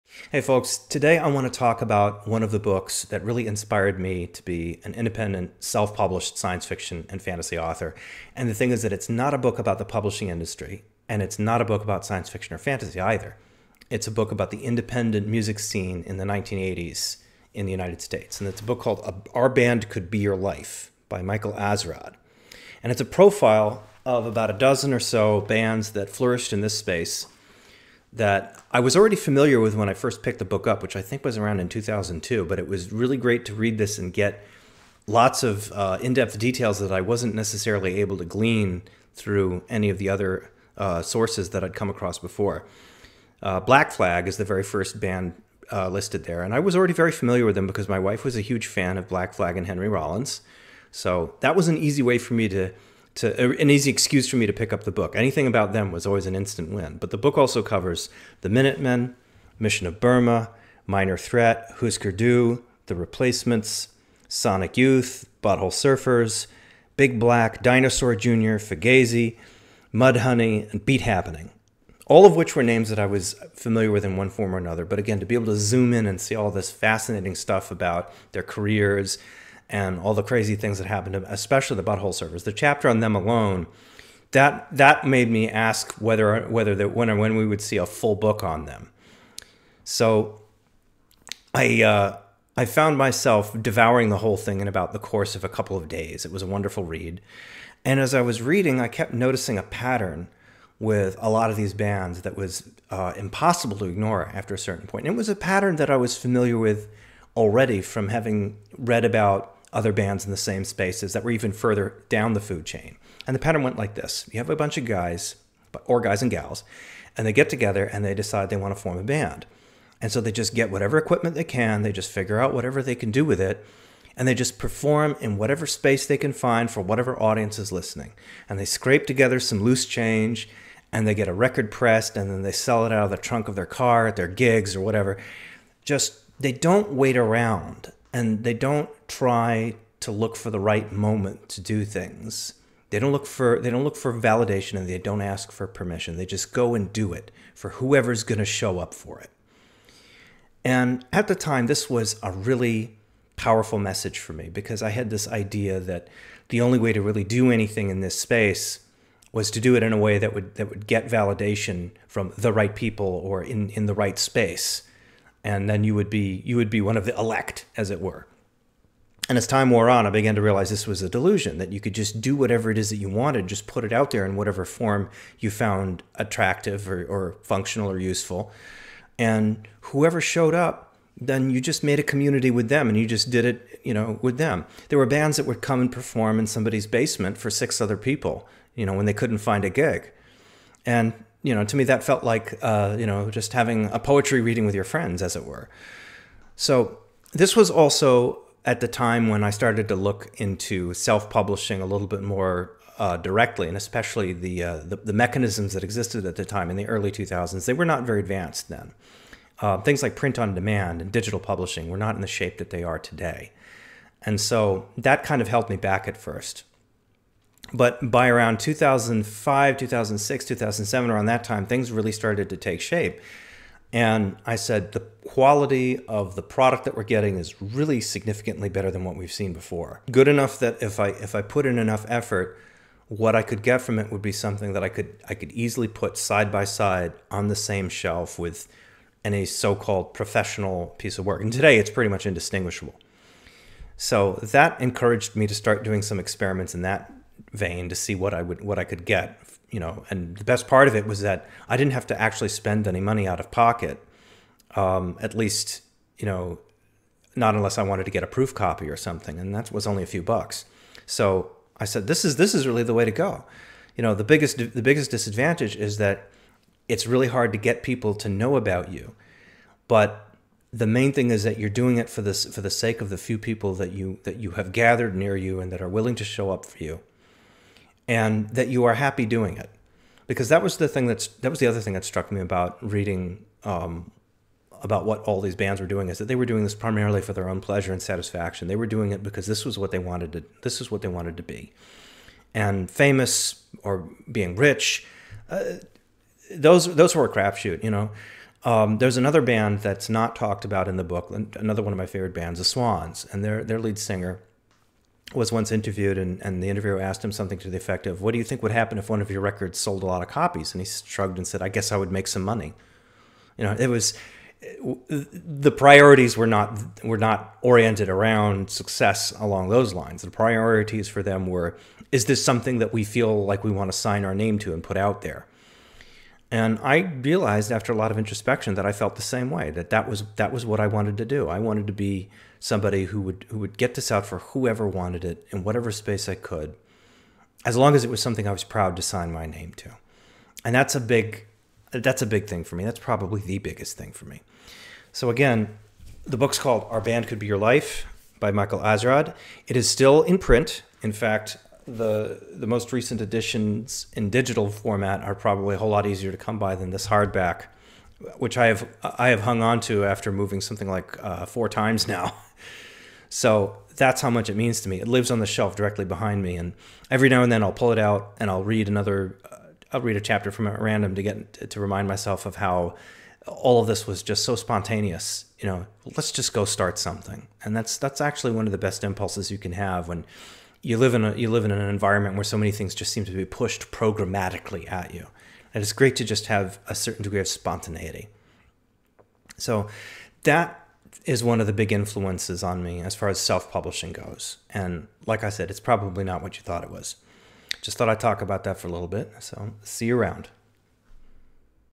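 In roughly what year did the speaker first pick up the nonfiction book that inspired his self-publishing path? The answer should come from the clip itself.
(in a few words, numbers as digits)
2002.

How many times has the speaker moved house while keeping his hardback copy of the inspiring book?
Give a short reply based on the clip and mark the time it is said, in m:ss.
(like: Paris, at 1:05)
4 times, at 6:01.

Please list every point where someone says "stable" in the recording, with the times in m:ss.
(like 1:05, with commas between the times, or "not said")
not said.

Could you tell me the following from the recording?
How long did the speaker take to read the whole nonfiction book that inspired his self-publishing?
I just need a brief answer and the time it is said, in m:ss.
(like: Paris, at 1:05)
a couple of days, at 1:35.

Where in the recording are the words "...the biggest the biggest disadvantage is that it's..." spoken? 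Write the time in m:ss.
4:24.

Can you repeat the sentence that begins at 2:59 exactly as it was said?
And whoever showed up, then you just made a community with them and you just did it, you know, with them.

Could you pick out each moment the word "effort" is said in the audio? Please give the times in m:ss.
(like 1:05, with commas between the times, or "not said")
3:52.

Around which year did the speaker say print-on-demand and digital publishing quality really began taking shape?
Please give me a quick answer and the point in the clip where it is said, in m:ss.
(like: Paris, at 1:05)
2005, at 3:38.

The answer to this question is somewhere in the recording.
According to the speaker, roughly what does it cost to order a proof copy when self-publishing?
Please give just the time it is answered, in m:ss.
4:20.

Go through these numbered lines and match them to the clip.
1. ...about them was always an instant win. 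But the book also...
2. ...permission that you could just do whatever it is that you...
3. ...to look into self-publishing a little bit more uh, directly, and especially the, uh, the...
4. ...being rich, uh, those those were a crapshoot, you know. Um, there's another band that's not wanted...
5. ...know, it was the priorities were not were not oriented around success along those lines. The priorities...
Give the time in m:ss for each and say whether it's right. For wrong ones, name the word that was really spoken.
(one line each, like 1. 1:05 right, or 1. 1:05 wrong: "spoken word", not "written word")
1. 0:55 right
2. 2:51 wrong: "delusion", not "permission"
3. 3:19 right
4. 4:54 wrong: "talked", not "wanted"
5. 5:13 right.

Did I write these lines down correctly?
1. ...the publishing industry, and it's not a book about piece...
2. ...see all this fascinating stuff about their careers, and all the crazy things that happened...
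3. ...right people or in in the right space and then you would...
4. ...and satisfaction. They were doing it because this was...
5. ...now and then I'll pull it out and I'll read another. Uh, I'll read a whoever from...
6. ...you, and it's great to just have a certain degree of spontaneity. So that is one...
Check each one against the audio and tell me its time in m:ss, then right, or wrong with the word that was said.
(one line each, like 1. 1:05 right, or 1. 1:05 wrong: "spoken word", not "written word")
1. 0:09 wrong: "science", not "piece"
2. 1:16 right
3. 2:42 right
4. 4:47 right
5. 6:07 wrong: "chapter", not "whoever"
6. 6:25 right.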